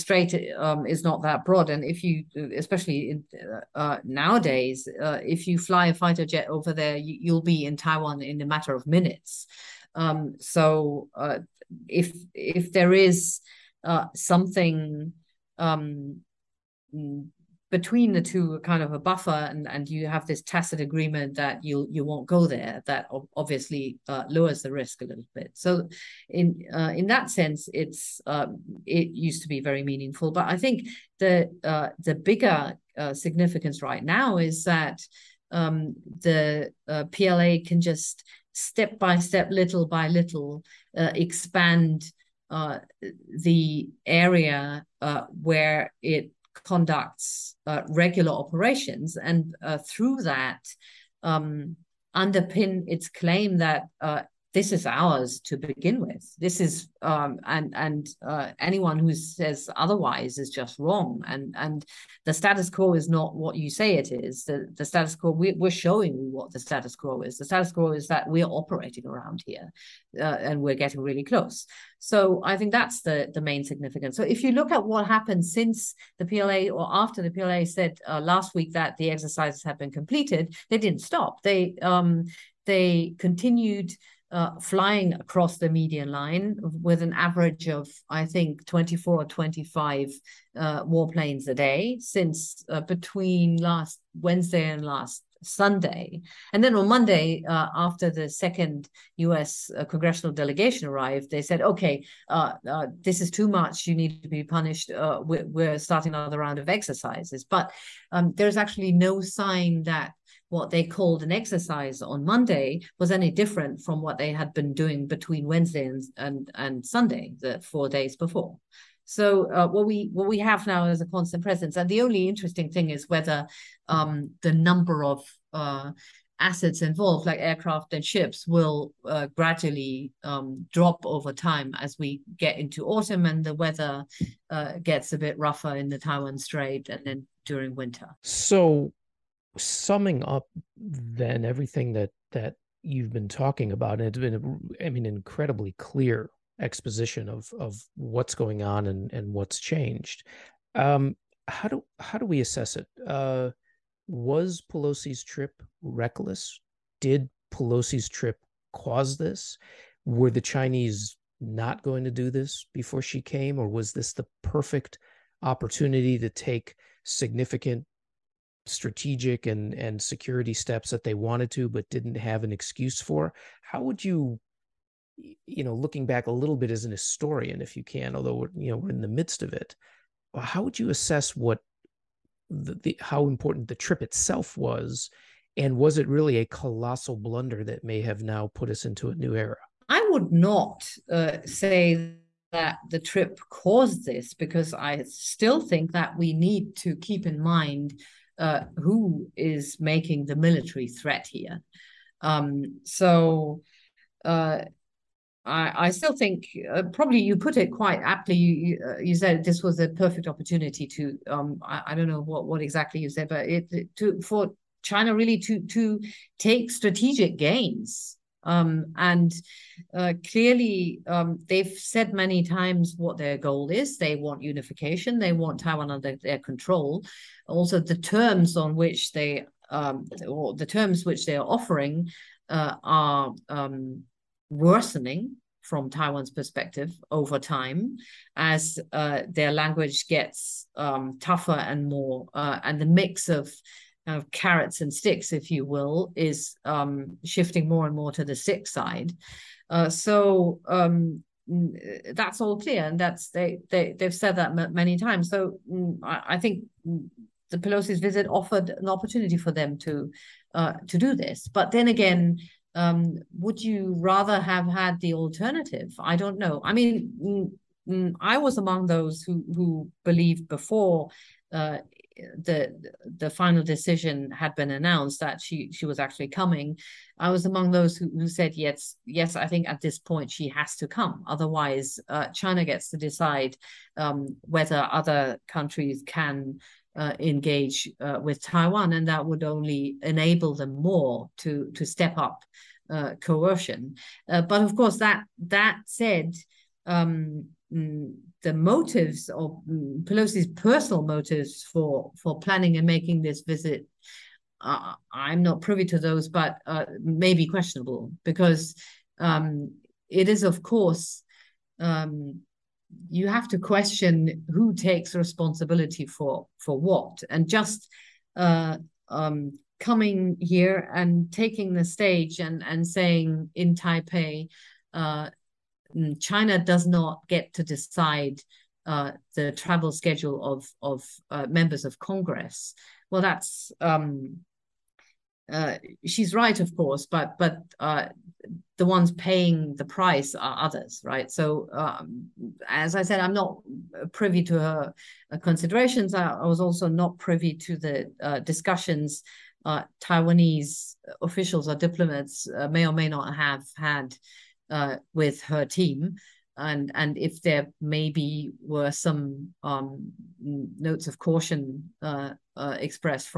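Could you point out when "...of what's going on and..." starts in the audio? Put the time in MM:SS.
02:27.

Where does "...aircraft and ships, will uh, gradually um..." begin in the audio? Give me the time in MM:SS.
02:07.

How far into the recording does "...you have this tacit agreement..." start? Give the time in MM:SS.
00:19.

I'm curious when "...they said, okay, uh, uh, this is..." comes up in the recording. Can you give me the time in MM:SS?
01:41.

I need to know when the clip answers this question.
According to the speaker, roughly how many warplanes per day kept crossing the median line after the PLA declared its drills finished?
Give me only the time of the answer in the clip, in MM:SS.
01:28.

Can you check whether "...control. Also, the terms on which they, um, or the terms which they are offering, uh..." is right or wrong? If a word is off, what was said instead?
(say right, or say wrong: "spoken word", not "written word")
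right.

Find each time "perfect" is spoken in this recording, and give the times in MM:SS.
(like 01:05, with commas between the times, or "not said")
02:44, 03:29.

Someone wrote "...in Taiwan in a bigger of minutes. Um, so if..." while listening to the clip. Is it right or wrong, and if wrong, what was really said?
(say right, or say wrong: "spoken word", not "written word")
wrong: "matter", not "bigger".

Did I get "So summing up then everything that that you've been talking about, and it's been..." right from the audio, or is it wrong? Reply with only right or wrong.
right.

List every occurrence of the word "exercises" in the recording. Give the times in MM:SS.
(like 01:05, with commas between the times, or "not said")
01:19, 01:46, 01:51.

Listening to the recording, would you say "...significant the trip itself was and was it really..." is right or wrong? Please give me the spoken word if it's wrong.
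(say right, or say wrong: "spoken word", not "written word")
wrong: "important", not "significant".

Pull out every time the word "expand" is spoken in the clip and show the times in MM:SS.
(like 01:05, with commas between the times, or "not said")
00:40.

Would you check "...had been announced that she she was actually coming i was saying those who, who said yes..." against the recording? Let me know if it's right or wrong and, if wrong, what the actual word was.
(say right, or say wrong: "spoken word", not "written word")
wrong: "among", not "saying".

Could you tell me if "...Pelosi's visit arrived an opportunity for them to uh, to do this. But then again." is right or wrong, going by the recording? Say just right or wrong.
wrong.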